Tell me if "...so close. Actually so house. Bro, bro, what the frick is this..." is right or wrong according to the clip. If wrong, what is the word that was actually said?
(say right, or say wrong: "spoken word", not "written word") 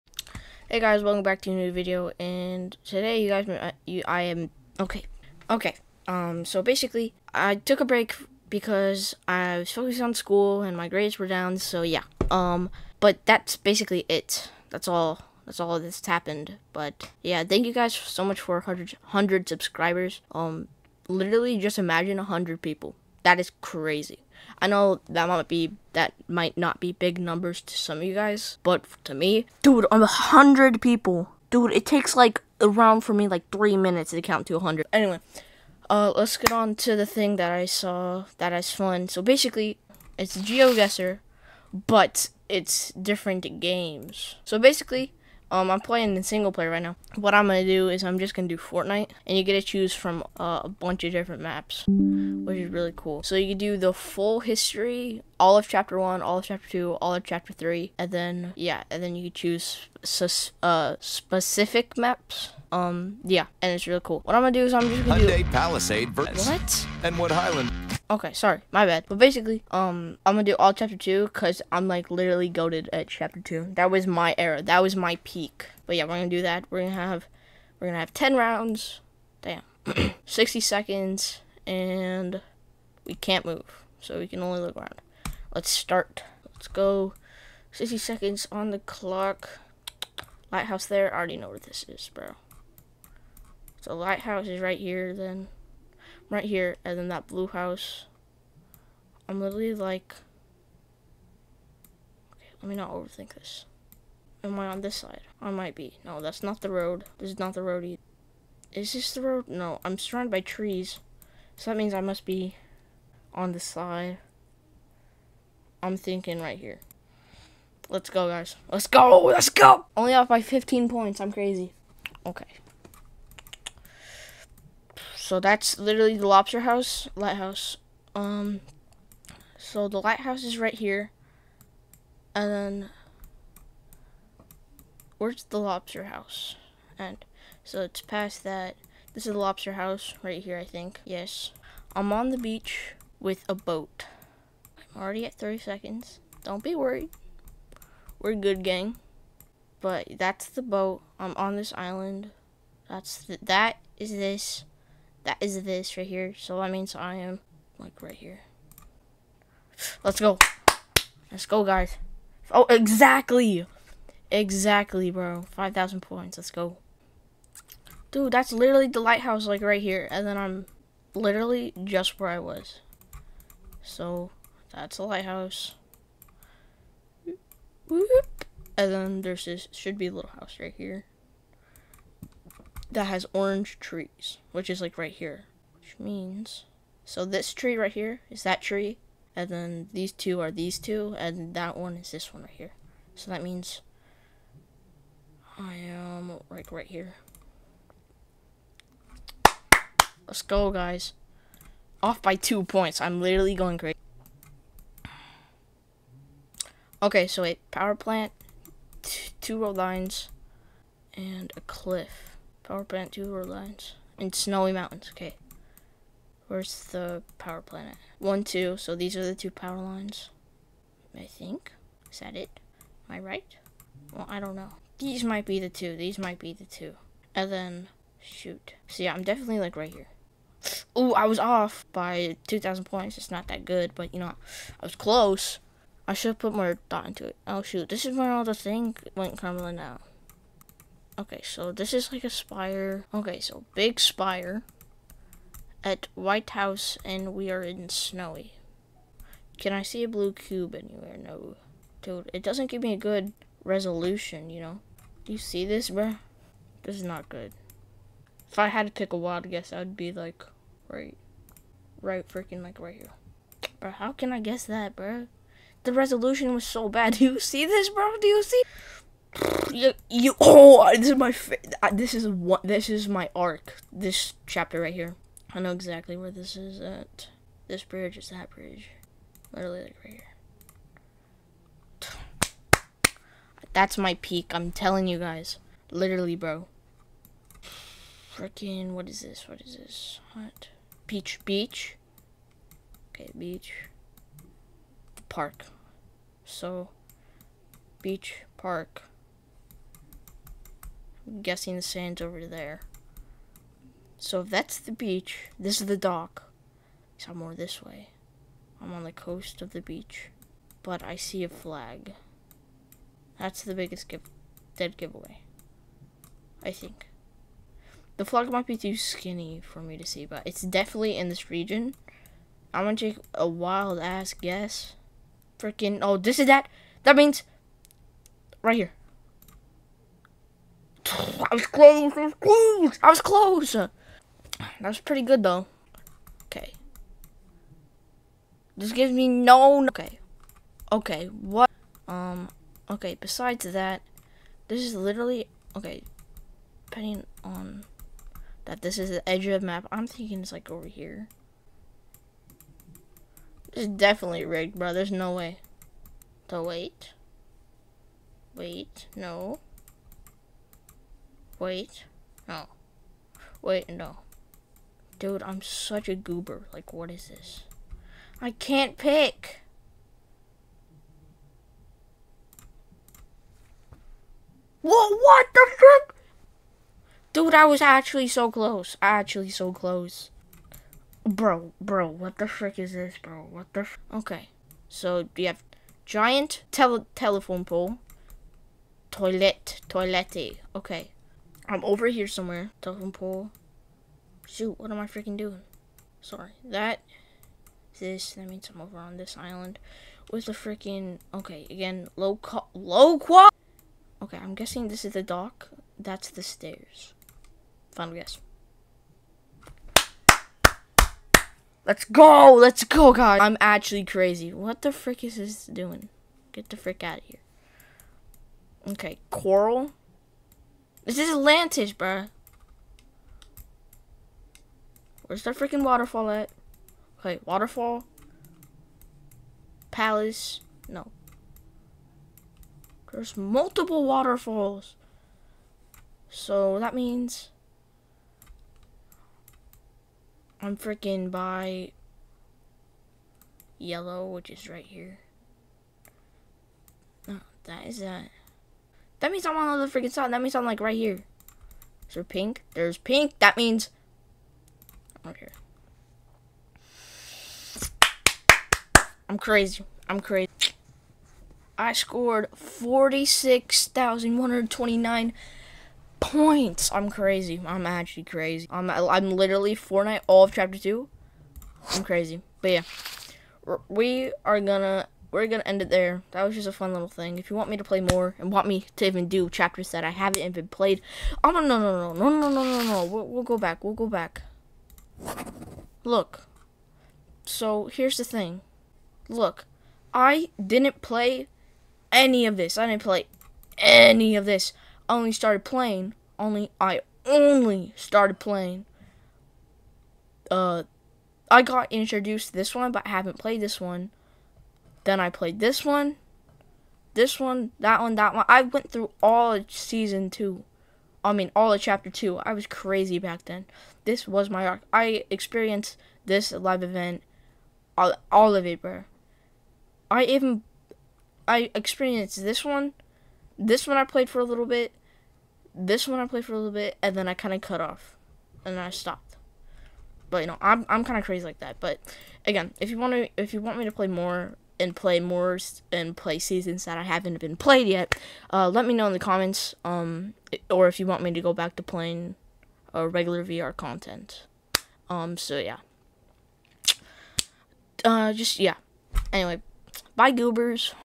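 wrong: "close", not "house".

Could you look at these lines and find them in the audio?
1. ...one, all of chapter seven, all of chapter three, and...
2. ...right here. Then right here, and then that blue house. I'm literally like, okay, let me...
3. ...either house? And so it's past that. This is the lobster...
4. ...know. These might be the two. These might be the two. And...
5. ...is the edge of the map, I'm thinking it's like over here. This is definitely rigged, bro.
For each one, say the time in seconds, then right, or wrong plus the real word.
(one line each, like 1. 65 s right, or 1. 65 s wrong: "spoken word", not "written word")
1. 55 s wrong: "two", not "seven"
2. 94 s right
3. 135 s wrong: "lobster", not "either"
4. 224 s right
5. 348 s right.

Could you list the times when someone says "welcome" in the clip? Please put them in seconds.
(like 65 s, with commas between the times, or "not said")
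1 s.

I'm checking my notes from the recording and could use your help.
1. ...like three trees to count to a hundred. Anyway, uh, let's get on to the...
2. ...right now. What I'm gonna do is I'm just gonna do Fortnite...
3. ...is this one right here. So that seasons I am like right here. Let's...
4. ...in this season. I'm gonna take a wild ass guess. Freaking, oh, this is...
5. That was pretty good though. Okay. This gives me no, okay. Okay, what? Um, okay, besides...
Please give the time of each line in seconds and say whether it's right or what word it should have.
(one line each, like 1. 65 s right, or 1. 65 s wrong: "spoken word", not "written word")
1. 33 s wrong: "minutes", not "trees"
2. 46 s right
3. 191 s wrong: "means", not "seasons"
4. 321 s wrong: "region", not "season"
5. 333 s right.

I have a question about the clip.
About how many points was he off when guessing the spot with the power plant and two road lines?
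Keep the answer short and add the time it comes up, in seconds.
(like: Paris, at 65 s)
2,000, at 232 s.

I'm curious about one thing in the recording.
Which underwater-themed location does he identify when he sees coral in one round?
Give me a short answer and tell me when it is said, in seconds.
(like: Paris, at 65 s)
Atlantis, at 421 s.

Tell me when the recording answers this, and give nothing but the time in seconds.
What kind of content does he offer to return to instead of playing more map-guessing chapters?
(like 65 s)
543 s.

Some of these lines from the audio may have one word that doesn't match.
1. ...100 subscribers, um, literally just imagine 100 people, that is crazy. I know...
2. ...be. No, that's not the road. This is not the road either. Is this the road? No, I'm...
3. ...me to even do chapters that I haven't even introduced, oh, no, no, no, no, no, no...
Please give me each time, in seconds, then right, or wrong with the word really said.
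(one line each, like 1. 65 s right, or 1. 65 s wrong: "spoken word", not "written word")
1. 19 s right
2. 105 s right
3. 478 s wrong: "played", not "introduced".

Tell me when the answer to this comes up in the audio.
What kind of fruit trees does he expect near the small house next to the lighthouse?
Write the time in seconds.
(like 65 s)
183 s.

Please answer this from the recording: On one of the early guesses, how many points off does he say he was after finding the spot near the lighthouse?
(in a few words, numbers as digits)
15.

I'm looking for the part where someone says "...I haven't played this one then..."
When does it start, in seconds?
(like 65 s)
503 s.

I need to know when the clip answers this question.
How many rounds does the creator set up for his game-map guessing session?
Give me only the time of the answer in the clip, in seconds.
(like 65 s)
78 s.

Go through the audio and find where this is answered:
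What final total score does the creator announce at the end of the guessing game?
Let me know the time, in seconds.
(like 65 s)
462 s.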